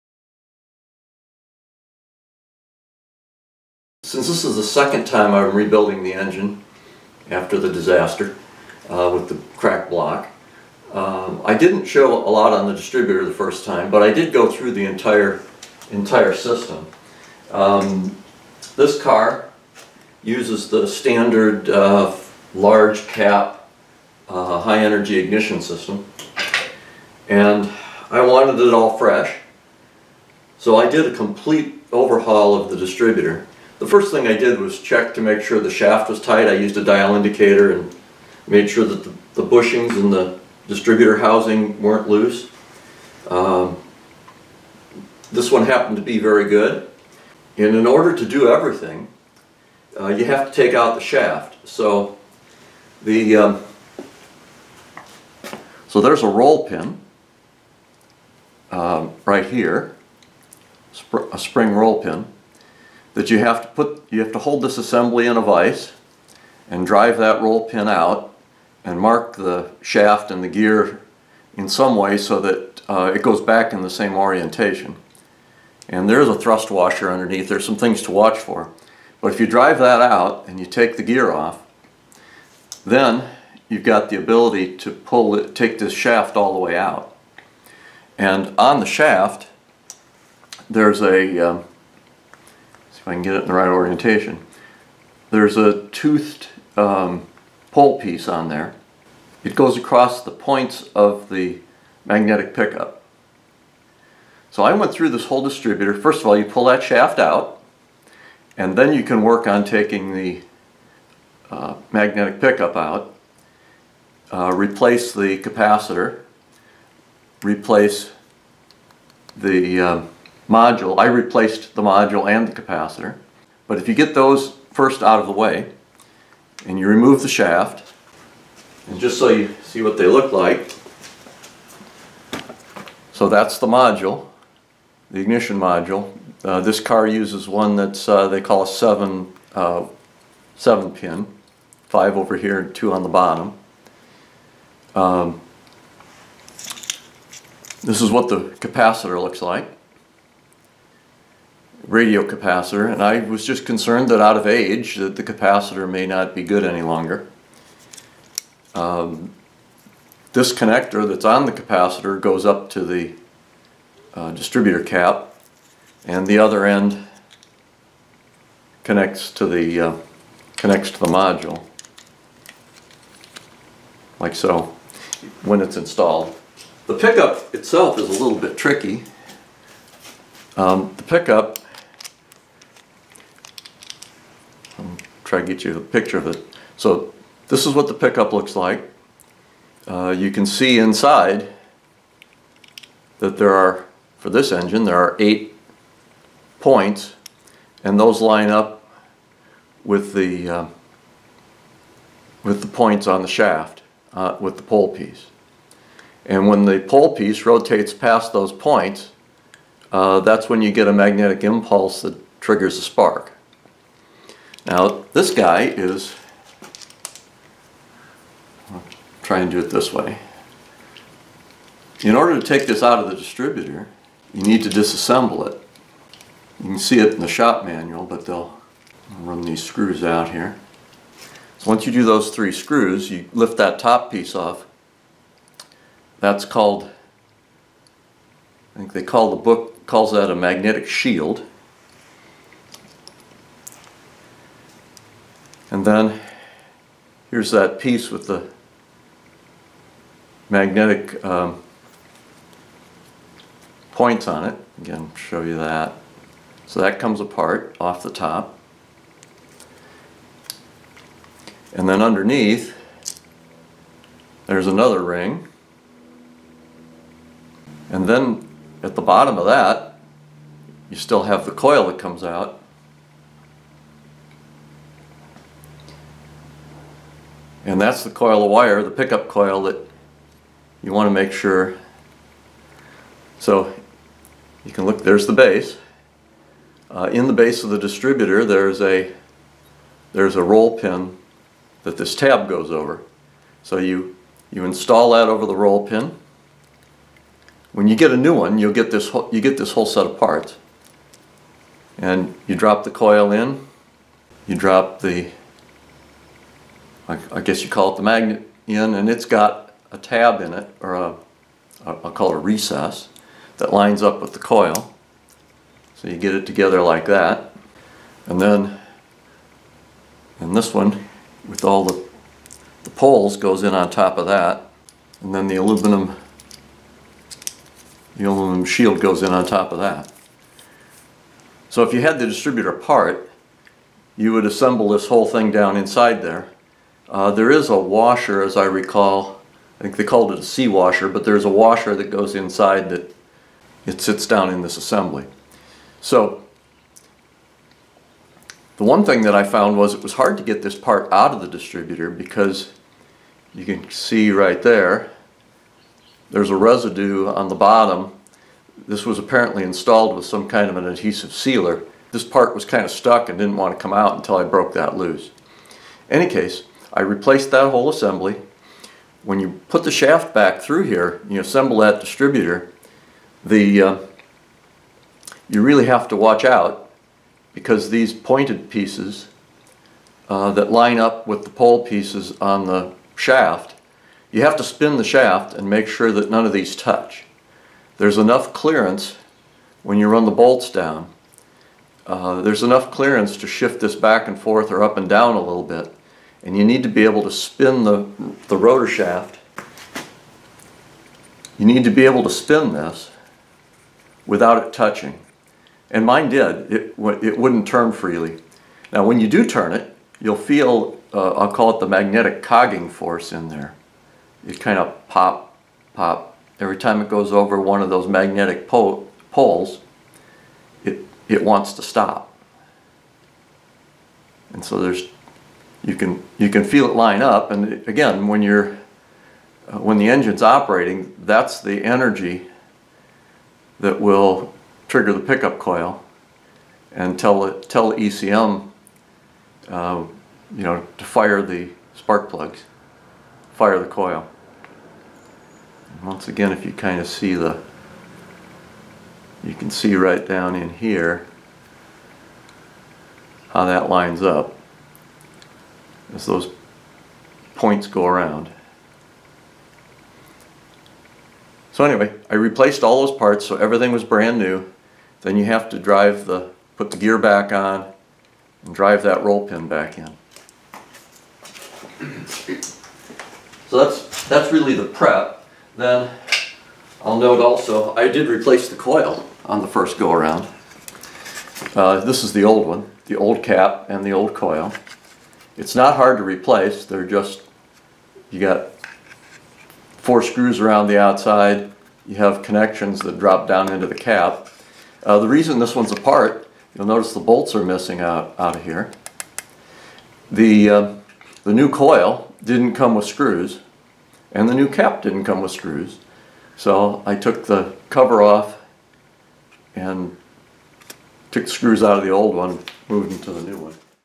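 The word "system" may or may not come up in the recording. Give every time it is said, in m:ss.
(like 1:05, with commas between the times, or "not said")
0:16, 0:25.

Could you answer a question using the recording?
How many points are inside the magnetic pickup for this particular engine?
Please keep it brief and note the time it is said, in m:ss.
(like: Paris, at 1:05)
8, at 3:15.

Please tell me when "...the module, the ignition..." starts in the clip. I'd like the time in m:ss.
2:13.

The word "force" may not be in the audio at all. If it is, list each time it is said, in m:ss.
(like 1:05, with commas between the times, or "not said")
6:52.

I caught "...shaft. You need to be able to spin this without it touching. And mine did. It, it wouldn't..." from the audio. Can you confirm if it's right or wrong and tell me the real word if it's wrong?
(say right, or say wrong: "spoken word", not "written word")
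right.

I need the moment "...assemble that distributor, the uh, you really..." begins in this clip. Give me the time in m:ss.
6:11.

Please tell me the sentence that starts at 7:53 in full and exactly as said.
So that's, that's really the prep.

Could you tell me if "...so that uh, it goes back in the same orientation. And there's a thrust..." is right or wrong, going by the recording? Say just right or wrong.
right.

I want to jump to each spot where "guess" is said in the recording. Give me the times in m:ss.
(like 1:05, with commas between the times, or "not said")
5:07.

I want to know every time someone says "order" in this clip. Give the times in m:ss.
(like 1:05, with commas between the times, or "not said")
0:47, 3:42.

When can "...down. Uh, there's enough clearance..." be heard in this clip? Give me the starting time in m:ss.
6:30.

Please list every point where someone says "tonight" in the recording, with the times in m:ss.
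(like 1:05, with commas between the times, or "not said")
not said.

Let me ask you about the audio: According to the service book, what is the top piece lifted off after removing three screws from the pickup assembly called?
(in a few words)
Magnetic shield.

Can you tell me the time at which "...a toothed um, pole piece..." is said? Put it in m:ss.
1:35.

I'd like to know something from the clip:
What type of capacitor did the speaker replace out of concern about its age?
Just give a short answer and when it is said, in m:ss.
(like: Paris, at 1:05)
Radio capacitor, at 2:31.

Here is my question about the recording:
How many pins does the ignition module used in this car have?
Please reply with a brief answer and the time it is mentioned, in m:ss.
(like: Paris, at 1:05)
7, at 2:20.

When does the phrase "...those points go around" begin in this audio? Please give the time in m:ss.
7:36.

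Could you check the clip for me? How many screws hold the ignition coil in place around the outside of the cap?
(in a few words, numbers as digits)
4.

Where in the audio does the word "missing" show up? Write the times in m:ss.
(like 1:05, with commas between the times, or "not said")
8:17.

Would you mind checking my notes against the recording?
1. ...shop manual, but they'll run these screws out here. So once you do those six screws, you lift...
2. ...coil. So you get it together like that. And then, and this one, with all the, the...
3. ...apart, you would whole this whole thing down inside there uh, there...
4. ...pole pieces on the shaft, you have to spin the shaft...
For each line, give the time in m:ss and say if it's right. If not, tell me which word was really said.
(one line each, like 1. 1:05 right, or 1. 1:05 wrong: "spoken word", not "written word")
1. 3:47 wrong: "three", not "six"
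2. 5:14 right
3. 5:32 wrong: "assemble", not "whole"
4. 6:21 right.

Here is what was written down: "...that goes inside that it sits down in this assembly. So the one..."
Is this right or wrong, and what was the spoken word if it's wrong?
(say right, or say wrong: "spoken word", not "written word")
right.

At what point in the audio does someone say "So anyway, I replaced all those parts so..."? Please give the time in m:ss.
7:41.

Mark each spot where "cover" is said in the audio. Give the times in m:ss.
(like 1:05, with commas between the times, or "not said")
8:27.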